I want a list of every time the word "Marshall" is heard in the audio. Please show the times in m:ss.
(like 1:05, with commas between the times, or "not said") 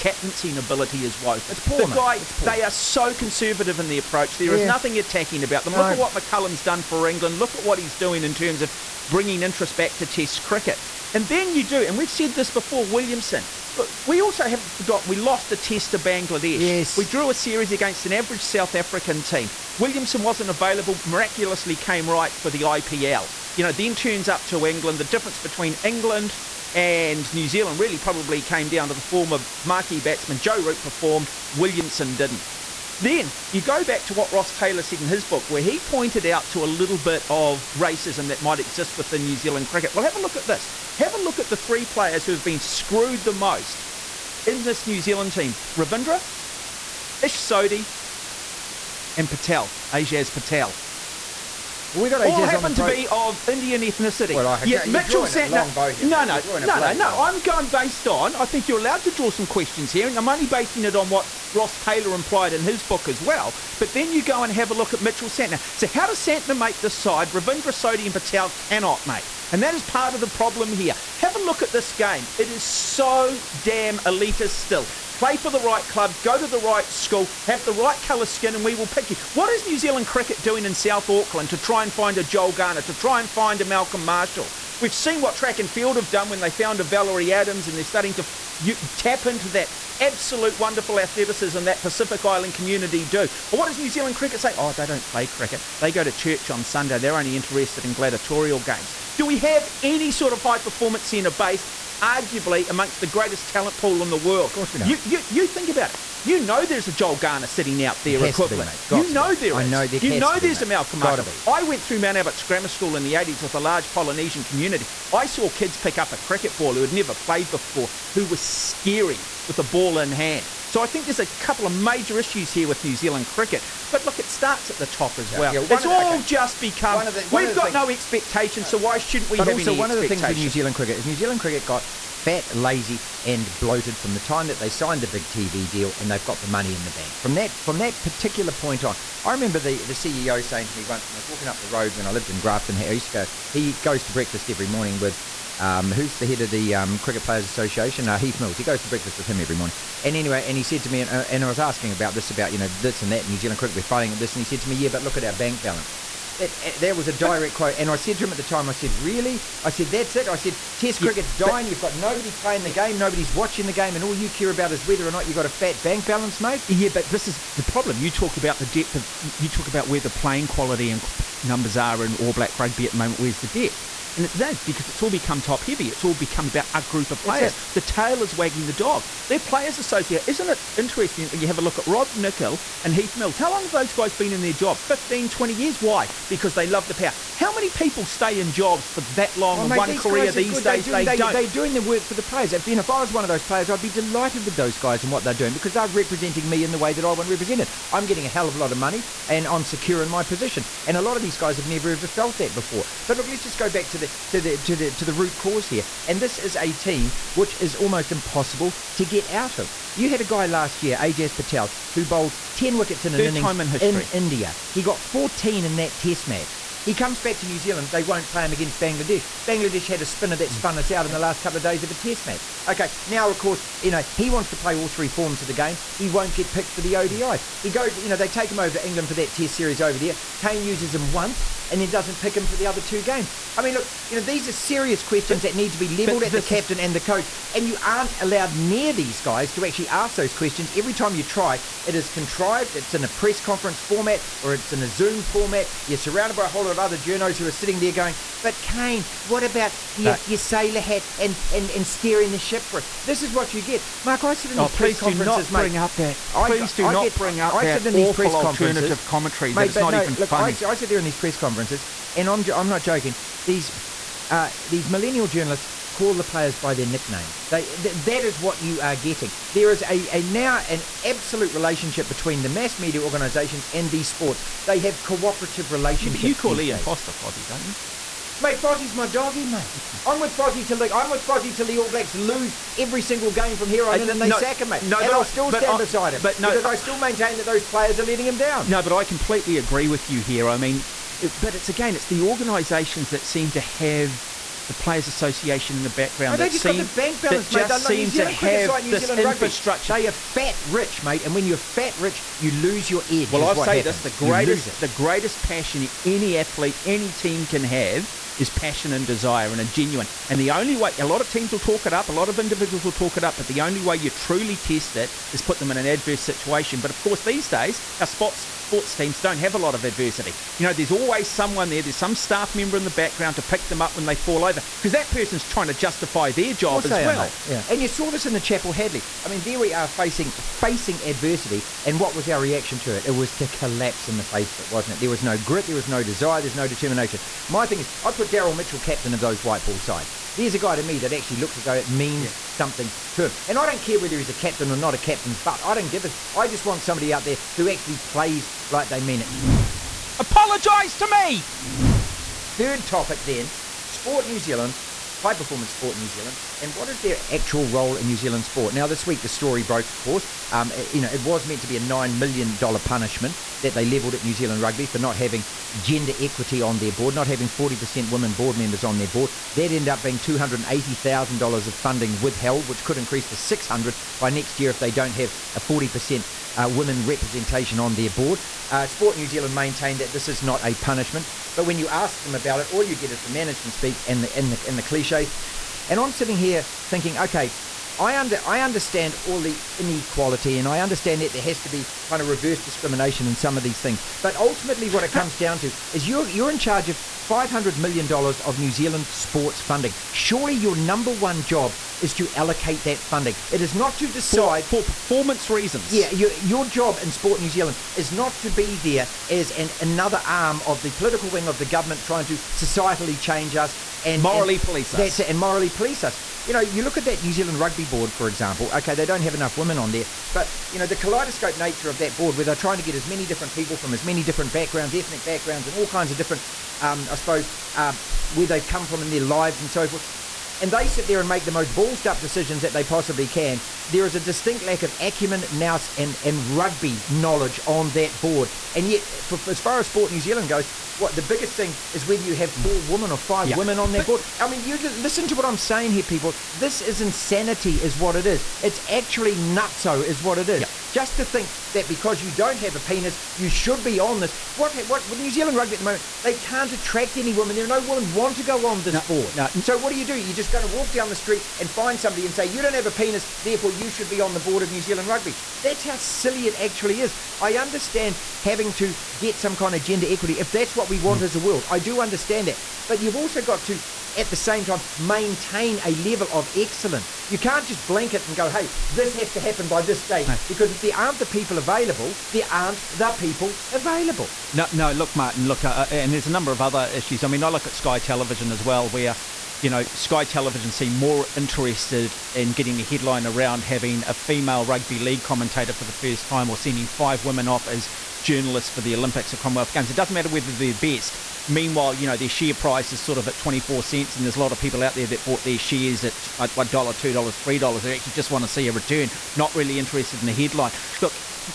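1:24, 1:50.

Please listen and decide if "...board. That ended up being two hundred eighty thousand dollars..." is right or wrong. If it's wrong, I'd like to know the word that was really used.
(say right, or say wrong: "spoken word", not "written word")
right.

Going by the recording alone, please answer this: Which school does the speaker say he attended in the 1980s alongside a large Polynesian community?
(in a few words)
Mount Albert Grammar School.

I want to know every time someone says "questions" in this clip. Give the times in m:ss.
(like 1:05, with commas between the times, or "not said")
0:59, 3:55, 4:00.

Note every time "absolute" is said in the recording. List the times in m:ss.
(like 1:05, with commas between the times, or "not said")
1:29, 4:31.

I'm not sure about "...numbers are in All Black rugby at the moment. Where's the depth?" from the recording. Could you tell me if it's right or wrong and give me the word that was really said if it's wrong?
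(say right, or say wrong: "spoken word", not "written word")
right.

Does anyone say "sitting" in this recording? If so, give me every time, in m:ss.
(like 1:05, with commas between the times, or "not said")
1:47, 4:07, 6:26.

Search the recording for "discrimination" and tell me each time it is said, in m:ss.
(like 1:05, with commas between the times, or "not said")
6:32.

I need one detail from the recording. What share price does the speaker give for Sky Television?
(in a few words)
24 cents.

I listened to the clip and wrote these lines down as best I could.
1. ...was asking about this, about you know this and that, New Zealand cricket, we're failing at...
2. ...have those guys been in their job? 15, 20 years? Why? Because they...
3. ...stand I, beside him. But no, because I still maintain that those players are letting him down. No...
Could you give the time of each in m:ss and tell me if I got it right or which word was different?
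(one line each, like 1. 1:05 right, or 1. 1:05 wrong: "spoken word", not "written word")
1. 2:31 right
2. 3:03 right
3. 4:45 right.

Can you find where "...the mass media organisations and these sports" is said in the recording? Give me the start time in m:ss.
4:32.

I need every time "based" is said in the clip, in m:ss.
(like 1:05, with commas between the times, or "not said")
0:57, 1:41.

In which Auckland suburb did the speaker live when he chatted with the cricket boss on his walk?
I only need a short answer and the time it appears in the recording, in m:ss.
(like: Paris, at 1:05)
Grafton, at 2:22.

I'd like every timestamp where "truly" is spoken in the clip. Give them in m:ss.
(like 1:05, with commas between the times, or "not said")
5:14.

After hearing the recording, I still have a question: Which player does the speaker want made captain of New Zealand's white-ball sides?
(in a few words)
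Daryl Mitchell.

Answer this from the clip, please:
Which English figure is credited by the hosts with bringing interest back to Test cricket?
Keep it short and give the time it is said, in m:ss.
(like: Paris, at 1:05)
McCullum, at 0:06.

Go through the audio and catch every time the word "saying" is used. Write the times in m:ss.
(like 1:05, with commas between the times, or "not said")
2:20, 7:25.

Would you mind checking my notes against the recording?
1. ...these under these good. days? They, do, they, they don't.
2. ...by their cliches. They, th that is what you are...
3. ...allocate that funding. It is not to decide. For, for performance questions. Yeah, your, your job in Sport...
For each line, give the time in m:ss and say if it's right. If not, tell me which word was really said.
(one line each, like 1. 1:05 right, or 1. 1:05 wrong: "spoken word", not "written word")
1. 3:09 wrong: "career", not "under"
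2. 4:26 wrong: "nicknames", not "cliches"
3. 6:42 wrong: "reasons", not "questions".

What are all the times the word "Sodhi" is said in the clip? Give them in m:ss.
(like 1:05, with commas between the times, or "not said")
0:47, 1:07.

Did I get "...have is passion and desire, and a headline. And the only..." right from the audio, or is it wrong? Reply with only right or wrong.
wrong.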